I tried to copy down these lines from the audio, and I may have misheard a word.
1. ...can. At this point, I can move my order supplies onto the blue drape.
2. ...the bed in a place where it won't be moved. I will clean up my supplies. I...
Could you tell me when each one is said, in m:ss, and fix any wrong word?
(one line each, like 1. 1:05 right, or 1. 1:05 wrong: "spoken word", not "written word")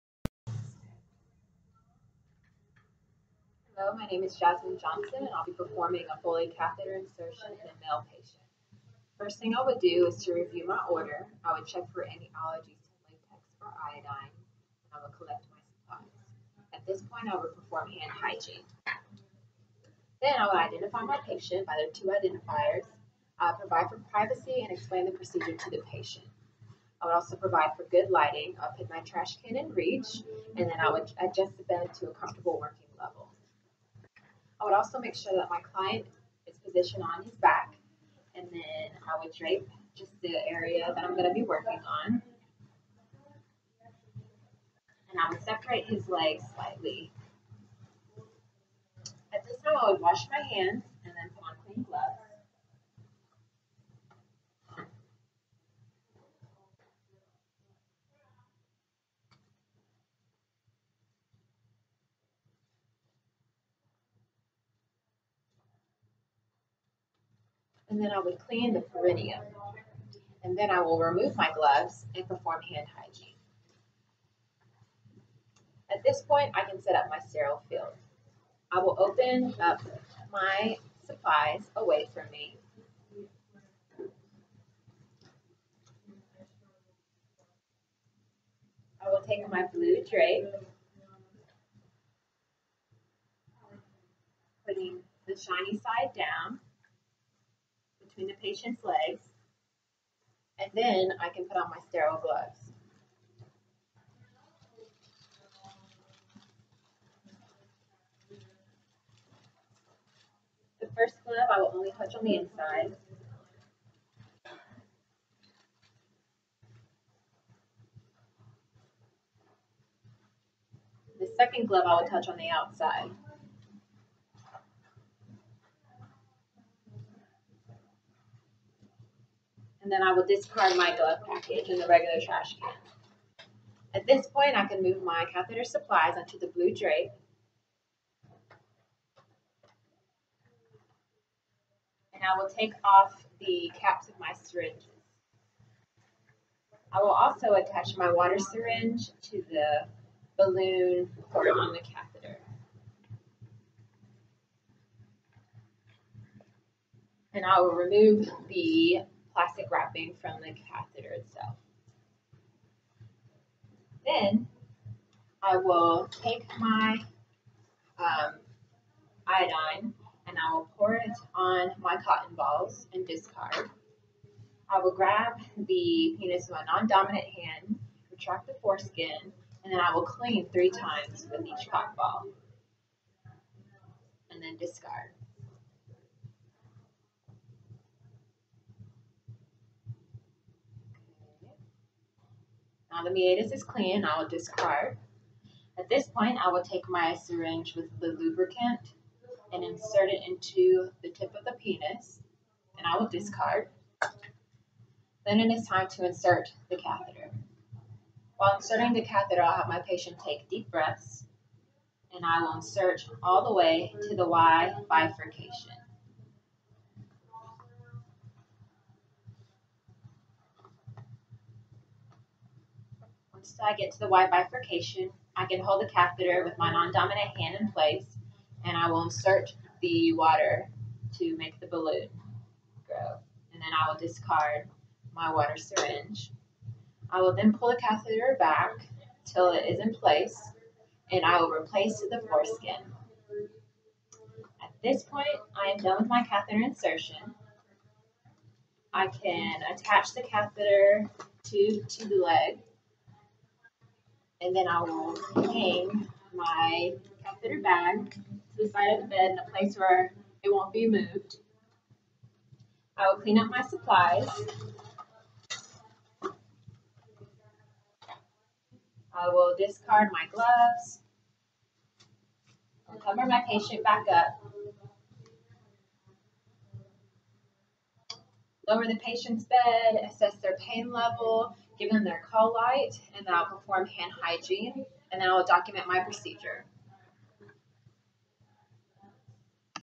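1. 2:12 wrong: "catheter", not "order"
2. 4:19 right.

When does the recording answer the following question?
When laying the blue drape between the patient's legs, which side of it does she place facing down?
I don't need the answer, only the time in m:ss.
1:35.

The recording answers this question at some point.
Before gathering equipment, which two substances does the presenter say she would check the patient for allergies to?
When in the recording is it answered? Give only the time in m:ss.
0:13.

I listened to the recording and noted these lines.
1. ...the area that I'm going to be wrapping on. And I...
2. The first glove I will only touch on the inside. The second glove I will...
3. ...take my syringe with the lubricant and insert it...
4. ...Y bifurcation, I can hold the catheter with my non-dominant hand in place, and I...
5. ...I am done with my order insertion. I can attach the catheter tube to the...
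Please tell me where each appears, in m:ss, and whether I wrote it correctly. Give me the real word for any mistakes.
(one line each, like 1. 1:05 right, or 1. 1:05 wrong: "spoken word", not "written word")
1. 0:40 wrong: "working", not "wrapping"
2. 1:50 right
3. 3:16 right
4. 3:44 right
5. 4:05 wrong: "catheter", not "order".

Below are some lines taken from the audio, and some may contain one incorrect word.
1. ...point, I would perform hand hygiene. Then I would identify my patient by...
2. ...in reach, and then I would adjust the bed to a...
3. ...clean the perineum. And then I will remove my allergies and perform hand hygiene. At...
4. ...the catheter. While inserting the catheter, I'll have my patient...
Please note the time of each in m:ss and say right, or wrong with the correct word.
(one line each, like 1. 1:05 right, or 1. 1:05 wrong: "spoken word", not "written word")
1. 0:17 right
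2. 0:29 right
3. 1:08 wrong: "gloves", not "allergies"
4. 3:26 right.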